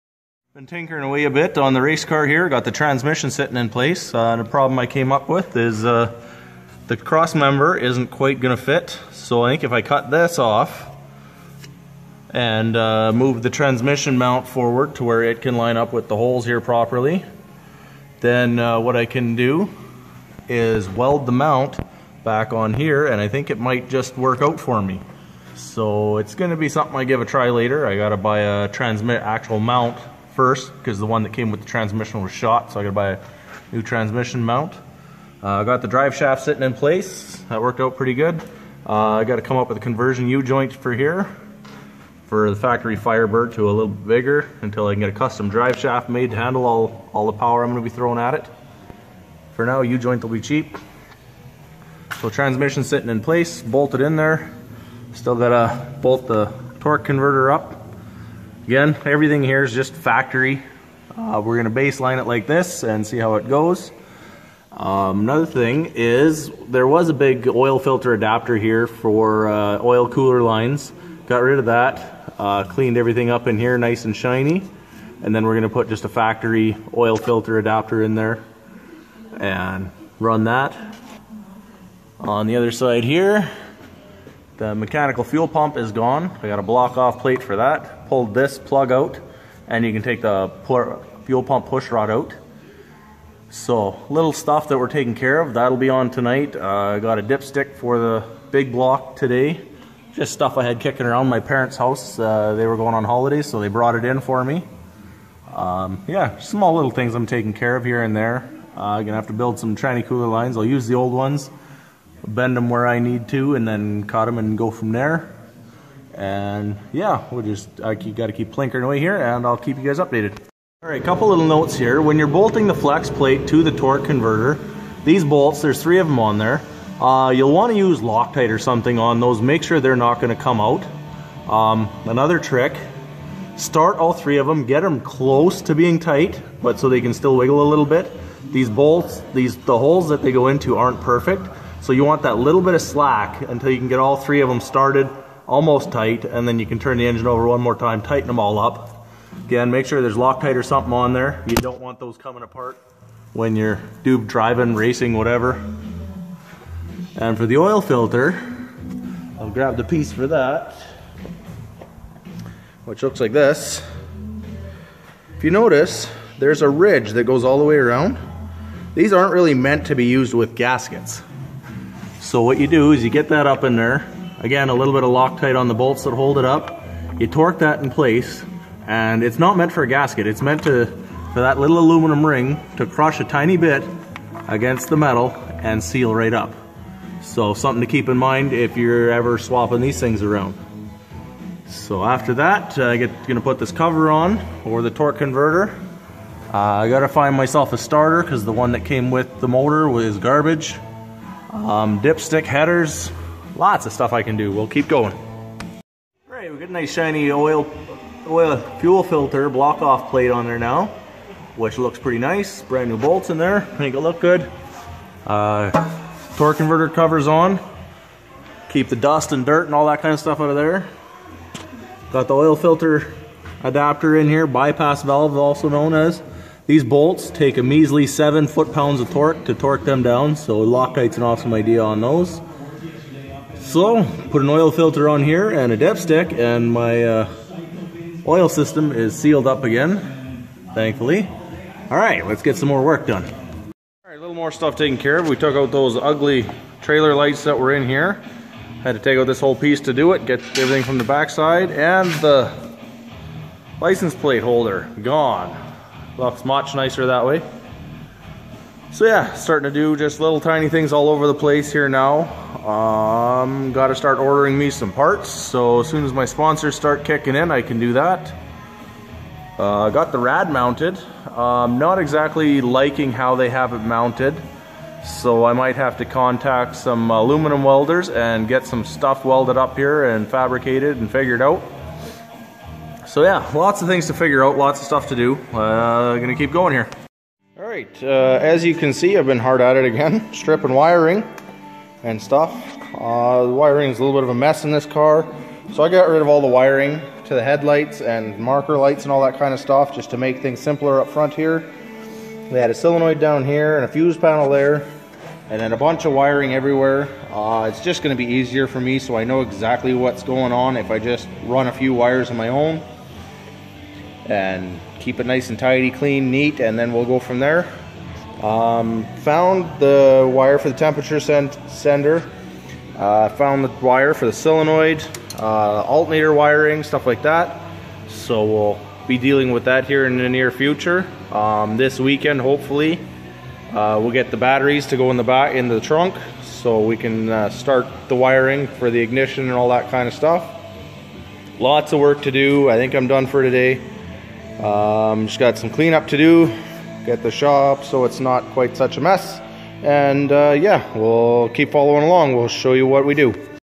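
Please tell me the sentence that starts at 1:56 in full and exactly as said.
And yeah, we just I got to keep plinkering away here, and I'll keep you guys updated.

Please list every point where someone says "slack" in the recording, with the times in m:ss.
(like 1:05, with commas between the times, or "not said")
2:22.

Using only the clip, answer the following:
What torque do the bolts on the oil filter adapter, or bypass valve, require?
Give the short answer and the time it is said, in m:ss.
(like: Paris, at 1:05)
7 foot-pounds, at 3:48.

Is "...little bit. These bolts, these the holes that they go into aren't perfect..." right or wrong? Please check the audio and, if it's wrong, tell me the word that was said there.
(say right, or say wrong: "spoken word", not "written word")
right.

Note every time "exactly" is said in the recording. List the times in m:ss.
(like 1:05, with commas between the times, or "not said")
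4:31, 5:09.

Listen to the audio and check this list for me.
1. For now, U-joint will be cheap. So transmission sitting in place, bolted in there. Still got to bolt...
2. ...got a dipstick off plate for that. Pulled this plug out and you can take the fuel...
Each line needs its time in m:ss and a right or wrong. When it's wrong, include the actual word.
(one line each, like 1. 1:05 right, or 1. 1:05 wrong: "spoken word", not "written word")
1. 0:49 right
2. 1:26 wrong: "block", not "dipstick".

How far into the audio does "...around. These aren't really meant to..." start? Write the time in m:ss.
2:47.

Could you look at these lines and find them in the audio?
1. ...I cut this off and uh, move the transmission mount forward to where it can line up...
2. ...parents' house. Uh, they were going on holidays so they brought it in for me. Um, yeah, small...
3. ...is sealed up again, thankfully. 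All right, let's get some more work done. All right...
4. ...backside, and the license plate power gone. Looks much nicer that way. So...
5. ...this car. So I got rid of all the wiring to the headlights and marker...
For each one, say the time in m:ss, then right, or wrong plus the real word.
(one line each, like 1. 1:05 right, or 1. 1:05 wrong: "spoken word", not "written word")
1. 0:09 right
2. 1:41 right
3. 3:58 right
4. 4:11 wrong: "holder", not "power"
5. 4:54 right.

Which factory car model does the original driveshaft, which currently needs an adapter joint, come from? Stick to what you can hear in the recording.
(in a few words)
Firebird.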